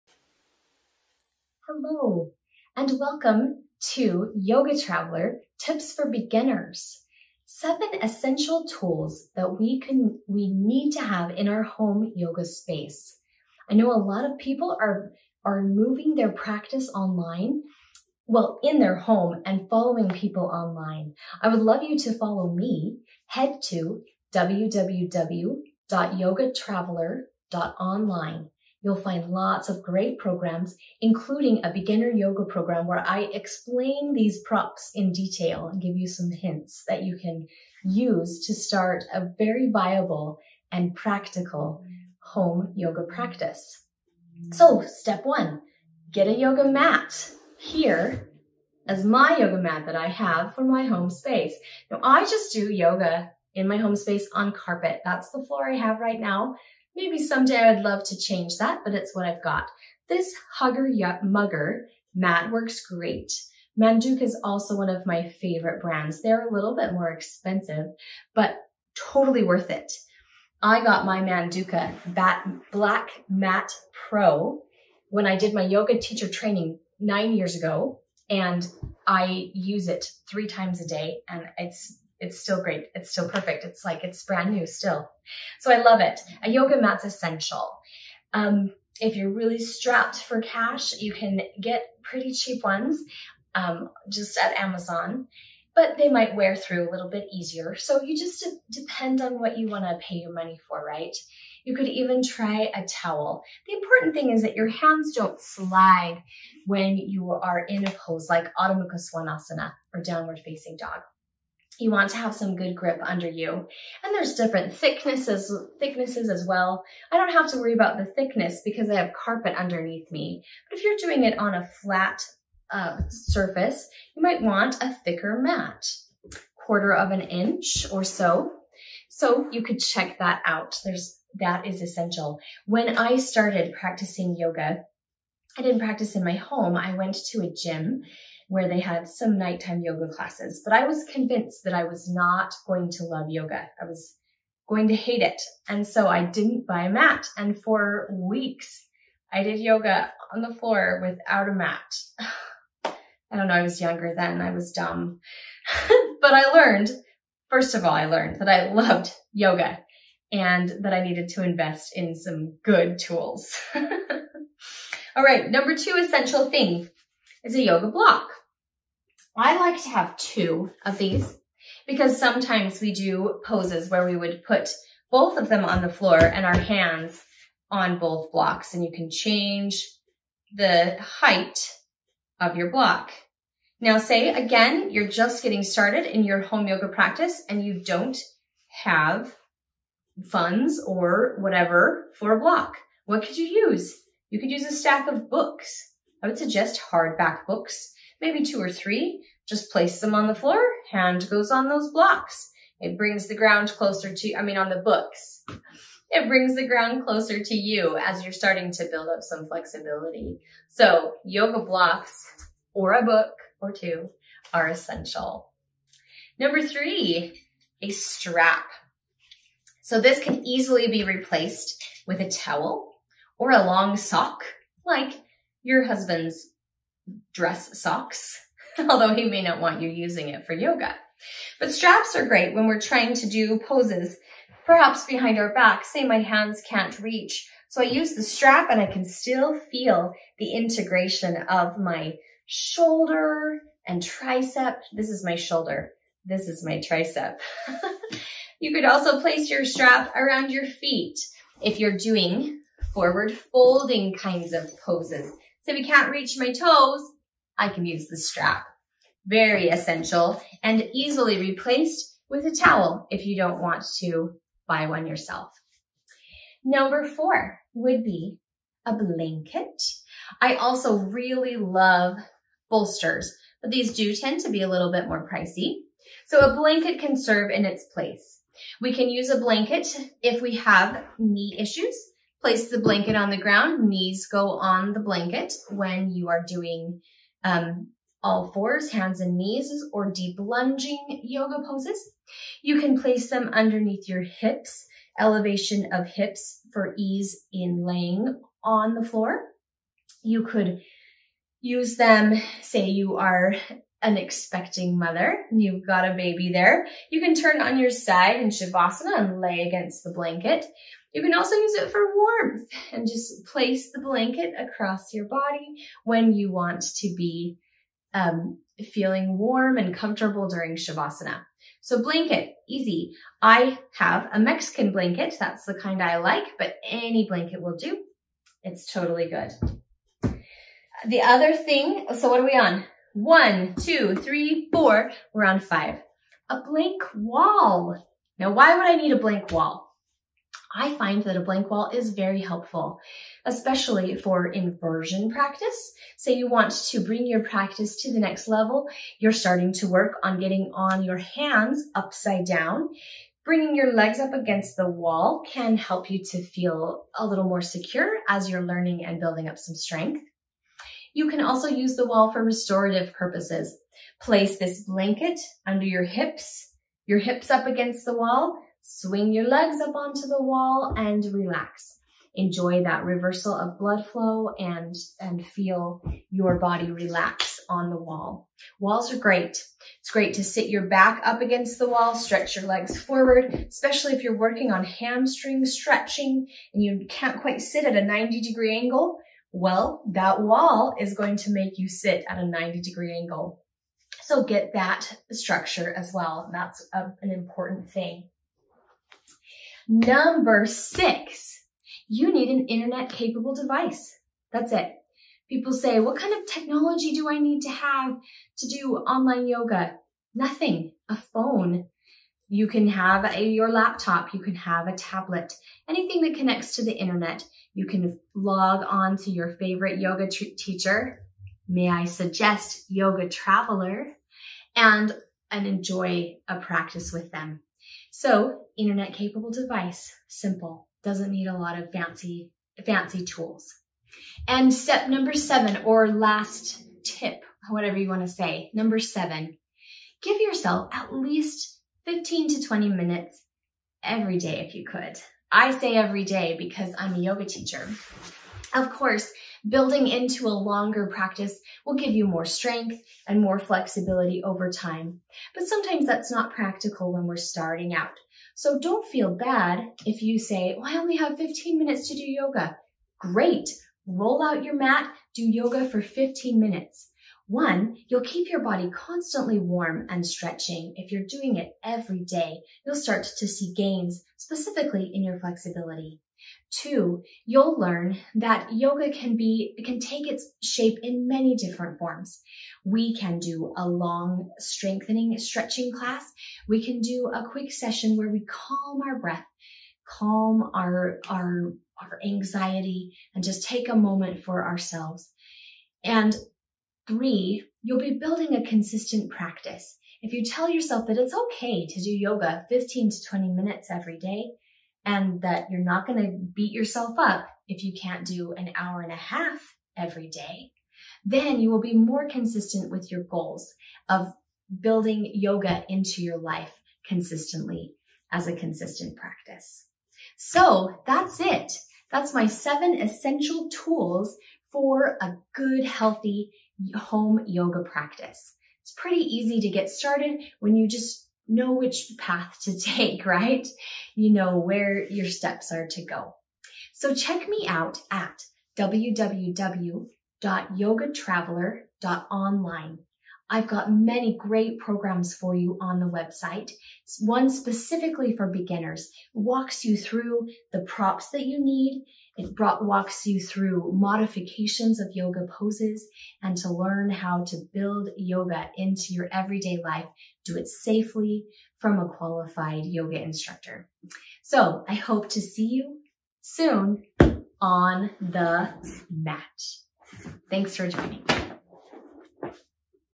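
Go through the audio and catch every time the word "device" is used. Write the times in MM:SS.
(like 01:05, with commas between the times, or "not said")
06:43, 07:09.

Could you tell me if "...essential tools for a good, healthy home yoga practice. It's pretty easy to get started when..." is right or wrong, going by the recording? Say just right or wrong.
right.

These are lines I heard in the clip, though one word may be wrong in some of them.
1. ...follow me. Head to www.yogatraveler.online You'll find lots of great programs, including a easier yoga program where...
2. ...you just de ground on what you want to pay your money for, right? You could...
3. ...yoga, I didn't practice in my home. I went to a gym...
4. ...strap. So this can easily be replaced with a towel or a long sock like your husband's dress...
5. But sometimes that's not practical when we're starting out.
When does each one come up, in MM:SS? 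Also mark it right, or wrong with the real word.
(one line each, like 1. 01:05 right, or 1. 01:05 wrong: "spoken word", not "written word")
1. 00:22 wrong: "beginner", not "easier"
2. 01:38 wrong: "depend", not "ground"
3. 02:14 right
4. 03:37 right
5. 07:35 right.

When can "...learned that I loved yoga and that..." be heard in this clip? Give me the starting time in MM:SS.
02:38.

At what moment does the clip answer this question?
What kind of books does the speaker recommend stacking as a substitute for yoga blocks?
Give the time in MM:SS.
03:16.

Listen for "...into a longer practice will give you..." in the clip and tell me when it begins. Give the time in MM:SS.
07:30.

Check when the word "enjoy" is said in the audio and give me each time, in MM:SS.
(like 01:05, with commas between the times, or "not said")
06:12, 07:05.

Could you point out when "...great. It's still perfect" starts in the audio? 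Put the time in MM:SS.
01:22.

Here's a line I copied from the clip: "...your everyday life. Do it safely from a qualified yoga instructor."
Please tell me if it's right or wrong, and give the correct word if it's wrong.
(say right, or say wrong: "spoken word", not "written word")
right.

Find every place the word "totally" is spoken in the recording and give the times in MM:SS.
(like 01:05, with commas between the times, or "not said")
01:08, 05:28.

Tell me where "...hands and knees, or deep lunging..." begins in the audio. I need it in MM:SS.
04:48.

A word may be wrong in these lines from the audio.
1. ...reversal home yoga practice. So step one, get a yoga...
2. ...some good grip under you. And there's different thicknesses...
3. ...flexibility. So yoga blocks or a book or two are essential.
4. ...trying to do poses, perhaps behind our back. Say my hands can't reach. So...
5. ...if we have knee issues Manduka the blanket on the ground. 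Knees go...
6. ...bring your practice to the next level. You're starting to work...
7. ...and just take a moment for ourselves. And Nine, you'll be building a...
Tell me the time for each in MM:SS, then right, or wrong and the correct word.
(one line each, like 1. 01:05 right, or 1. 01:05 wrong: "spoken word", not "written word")
1. 00:40 wrong: "practical", not "reversal"
2. 01:52 right
3. 03:29 right
4. 03:52 right
5. 04:40 wrong: "Place", not "Manduka"
6. 05:47 right
7. 08:13 wrong: "Three", not "Nine".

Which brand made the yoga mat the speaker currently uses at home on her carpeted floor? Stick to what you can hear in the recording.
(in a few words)
Hugger Mugger.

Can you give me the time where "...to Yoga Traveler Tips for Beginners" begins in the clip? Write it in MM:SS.
00:03.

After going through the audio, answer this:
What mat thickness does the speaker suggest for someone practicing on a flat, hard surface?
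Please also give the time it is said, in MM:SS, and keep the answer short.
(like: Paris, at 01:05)
quarter of an inch, at 02:06.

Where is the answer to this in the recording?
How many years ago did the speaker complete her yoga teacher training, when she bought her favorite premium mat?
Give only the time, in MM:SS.
01:16.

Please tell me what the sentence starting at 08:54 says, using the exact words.
You know where your steps are to go.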